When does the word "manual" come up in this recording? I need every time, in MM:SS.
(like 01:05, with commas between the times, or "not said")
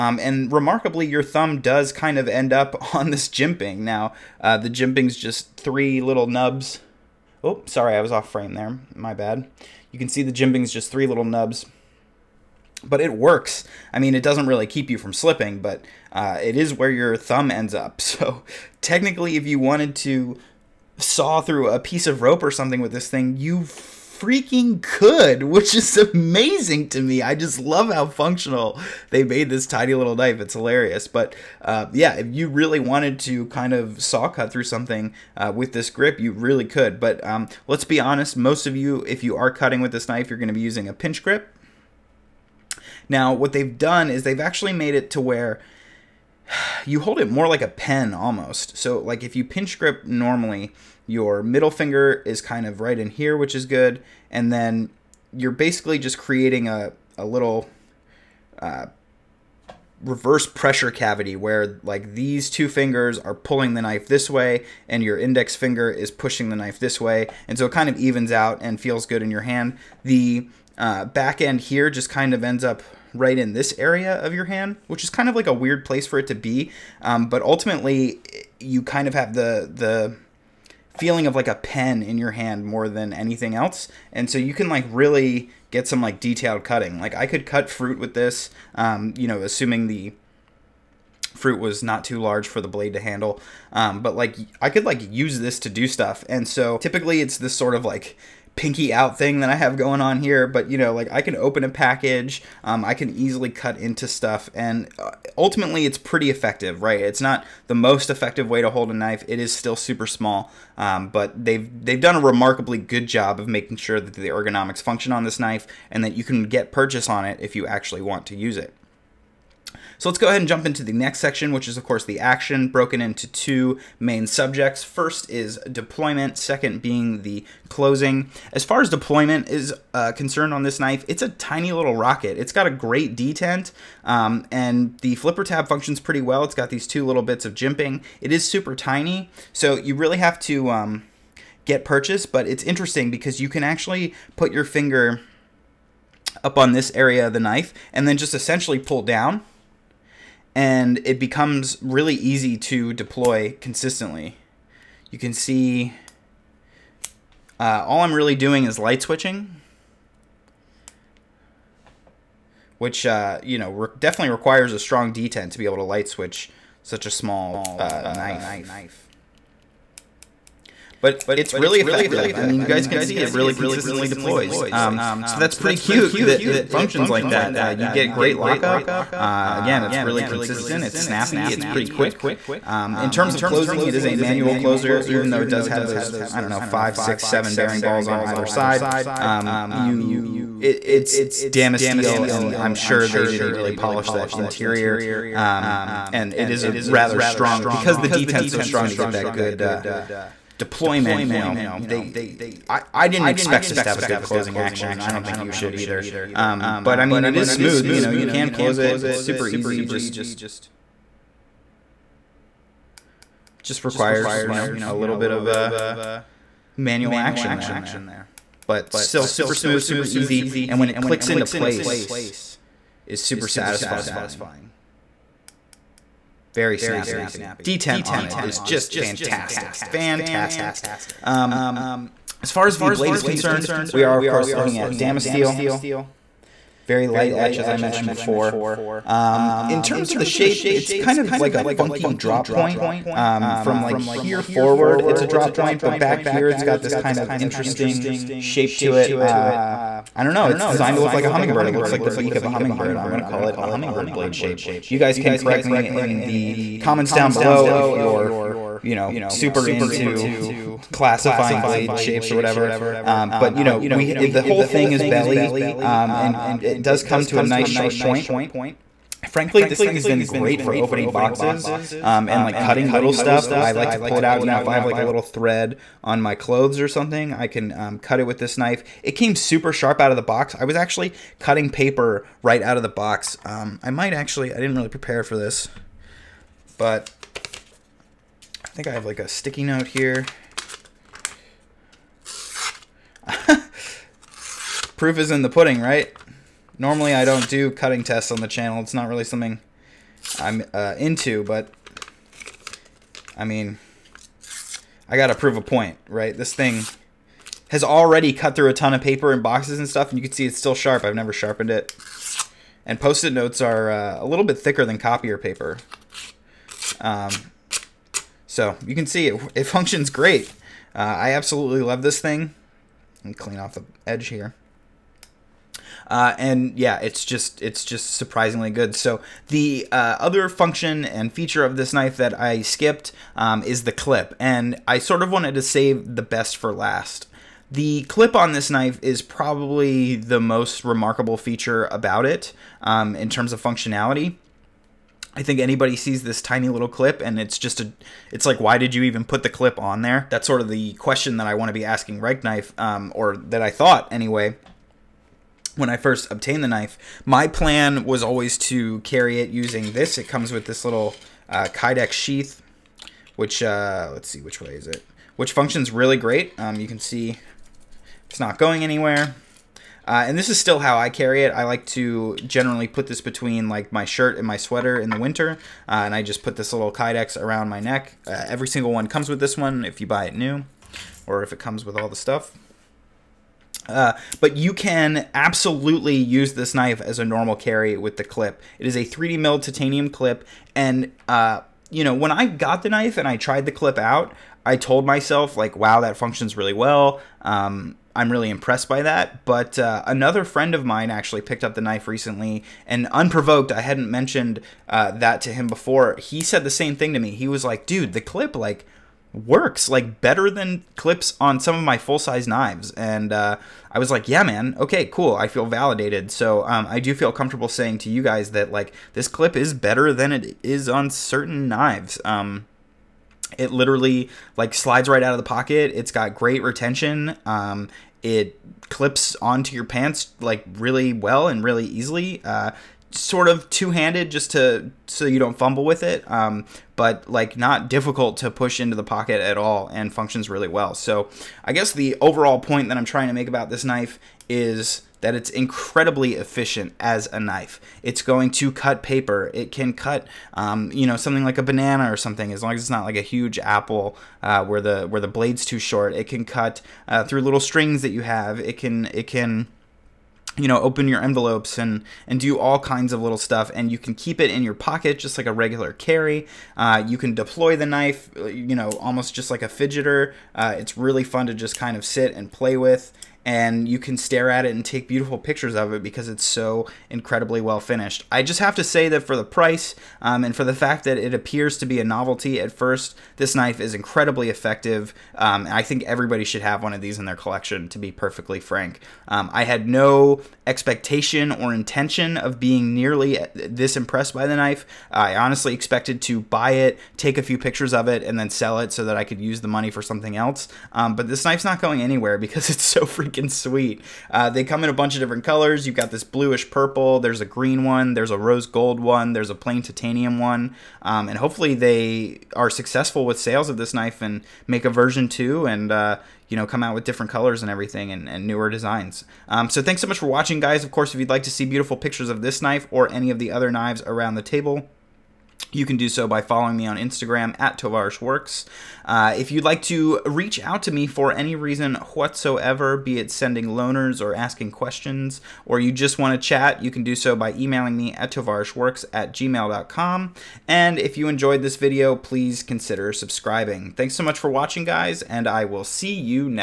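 03:04, 03:36.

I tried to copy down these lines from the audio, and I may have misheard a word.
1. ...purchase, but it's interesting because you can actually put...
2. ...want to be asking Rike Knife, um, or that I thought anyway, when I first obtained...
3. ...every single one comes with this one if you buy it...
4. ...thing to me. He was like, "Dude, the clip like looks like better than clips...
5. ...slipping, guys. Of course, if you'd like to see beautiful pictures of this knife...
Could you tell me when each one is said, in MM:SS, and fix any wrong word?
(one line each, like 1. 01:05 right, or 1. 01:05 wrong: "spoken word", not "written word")
1. 02:21 right
2. 05:51 right
3. 06:18 right
4. 06:46 wrong: "works", not "looks"
5. 08:40 wrong: "watching", not "slipping".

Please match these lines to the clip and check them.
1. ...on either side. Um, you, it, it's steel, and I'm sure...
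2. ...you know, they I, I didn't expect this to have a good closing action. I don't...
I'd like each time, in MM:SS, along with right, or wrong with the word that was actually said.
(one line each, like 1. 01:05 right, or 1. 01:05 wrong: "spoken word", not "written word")
1. 03:08 right
2. 03:21 right.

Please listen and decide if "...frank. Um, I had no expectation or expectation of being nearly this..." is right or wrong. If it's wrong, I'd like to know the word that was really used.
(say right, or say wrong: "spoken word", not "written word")
wrong: "intention", not "expectation".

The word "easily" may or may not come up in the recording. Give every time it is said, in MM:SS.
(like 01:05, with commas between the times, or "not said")
01:43, 07:11.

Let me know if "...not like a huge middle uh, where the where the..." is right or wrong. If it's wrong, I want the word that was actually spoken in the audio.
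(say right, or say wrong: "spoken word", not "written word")
wrong: "apple", not "middle".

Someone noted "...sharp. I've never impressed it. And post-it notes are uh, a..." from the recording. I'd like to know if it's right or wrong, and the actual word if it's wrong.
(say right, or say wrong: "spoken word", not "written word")
wrong: "sharpened", not "impressed".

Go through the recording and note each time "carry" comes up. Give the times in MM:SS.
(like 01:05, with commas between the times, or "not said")
05:59, 06:11, 06:27, 07:45.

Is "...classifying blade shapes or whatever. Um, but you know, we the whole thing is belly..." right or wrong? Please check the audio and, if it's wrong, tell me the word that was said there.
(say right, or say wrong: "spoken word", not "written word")
right.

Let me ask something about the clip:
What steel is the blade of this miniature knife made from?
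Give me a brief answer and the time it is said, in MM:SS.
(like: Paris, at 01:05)
Damasteel, at 03:54.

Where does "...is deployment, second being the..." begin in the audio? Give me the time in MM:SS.
02:05.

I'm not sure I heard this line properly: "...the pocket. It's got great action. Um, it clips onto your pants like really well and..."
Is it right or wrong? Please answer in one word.
wrong.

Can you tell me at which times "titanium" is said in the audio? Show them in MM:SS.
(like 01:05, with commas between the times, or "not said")
06:29, 08:29.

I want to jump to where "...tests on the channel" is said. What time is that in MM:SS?
04:58.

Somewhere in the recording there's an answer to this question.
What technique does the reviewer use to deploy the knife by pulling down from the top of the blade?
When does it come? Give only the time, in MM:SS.
02:38.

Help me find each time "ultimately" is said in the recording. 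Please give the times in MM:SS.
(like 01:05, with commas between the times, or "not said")
01:17, 01:45.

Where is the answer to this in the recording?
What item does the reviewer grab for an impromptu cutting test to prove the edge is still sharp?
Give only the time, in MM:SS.
04:49.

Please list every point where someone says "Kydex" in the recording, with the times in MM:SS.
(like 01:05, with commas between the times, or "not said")
06:01, 06:16.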